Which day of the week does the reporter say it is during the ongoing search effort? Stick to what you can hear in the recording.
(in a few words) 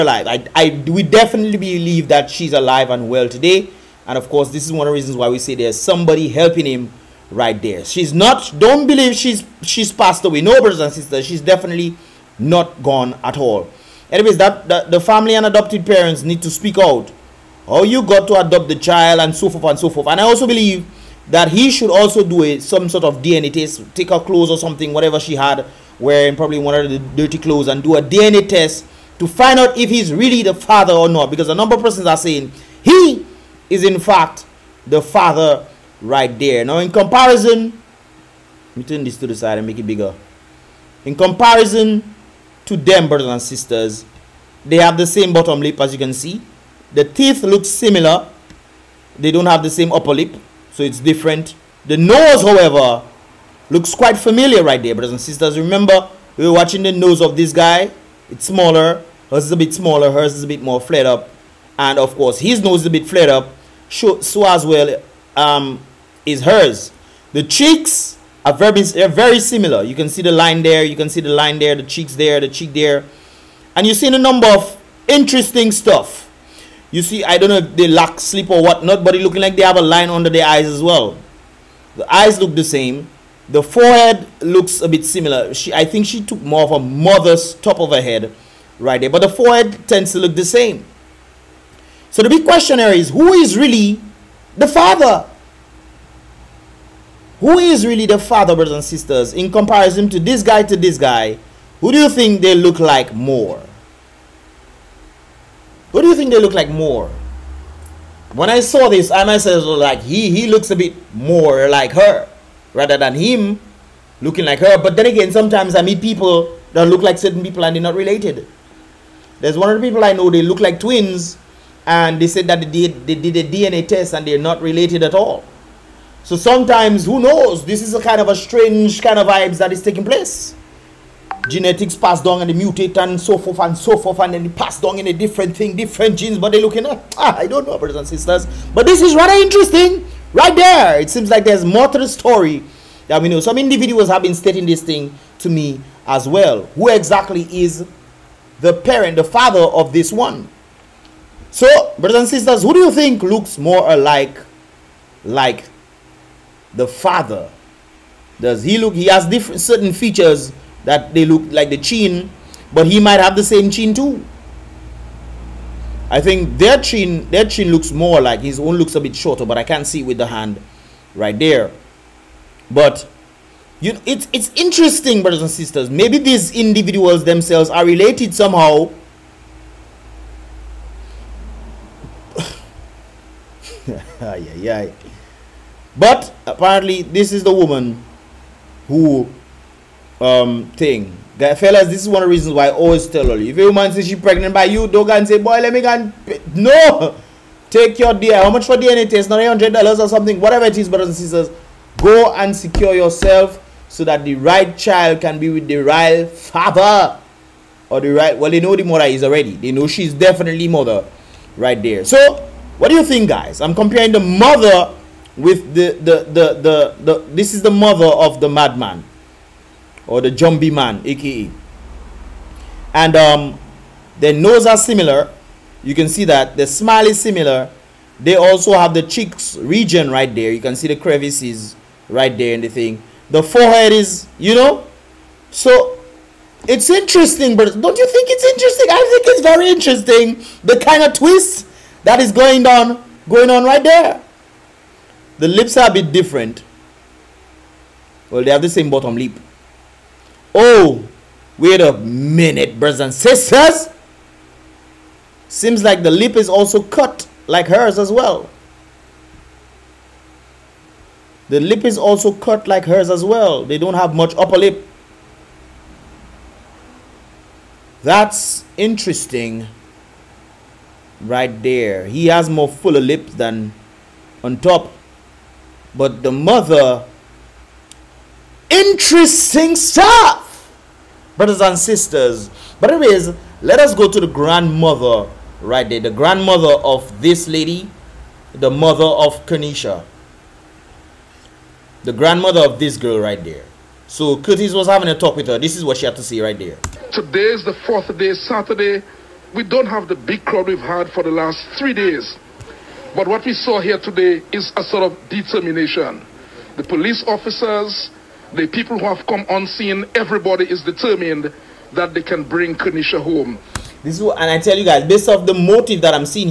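Saturday.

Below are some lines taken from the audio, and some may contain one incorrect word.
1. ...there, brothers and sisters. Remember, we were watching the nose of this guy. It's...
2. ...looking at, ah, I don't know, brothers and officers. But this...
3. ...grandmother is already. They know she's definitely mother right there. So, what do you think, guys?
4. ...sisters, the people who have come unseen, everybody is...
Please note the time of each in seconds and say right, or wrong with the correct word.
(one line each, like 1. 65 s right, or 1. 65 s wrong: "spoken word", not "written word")
1. 54 s right
2. 136 s wrong: "sisters", not "officers"
3. 208 s wrong: "mother", not "grandmother"
4. 307 s wrong: "officers", not "sisters".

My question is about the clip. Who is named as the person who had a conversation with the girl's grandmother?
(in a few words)
Curtis.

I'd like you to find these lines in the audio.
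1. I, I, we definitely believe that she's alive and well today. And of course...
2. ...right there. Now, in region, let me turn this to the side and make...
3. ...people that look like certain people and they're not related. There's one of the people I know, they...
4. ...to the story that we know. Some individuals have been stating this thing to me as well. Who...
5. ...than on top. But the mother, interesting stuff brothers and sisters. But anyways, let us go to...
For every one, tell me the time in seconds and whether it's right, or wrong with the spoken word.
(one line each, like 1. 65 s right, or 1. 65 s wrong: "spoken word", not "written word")
1. 0 s right
2. 36 s wrong: "comparison", not "region"
3. 116 s right
4. 141 s right
5. 273 s right.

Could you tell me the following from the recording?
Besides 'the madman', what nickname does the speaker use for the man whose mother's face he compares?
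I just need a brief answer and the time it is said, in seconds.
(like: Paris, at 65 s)
Jumbie Man, at 220 s.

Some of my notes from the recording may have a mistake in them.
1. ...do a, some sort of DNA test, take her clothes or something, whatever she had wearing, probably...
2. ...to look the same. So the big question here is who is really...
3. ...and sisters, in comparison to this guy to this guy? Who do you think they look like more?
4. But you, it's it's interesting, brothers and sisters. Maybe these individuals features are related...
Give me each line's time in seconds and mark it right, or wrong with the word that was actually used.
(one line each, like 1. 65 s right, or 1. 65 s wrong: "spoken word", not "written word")
1. 22 s right
2. 90 s right
3. 98 s right
4. 172 s wrong: "themselves", not "features".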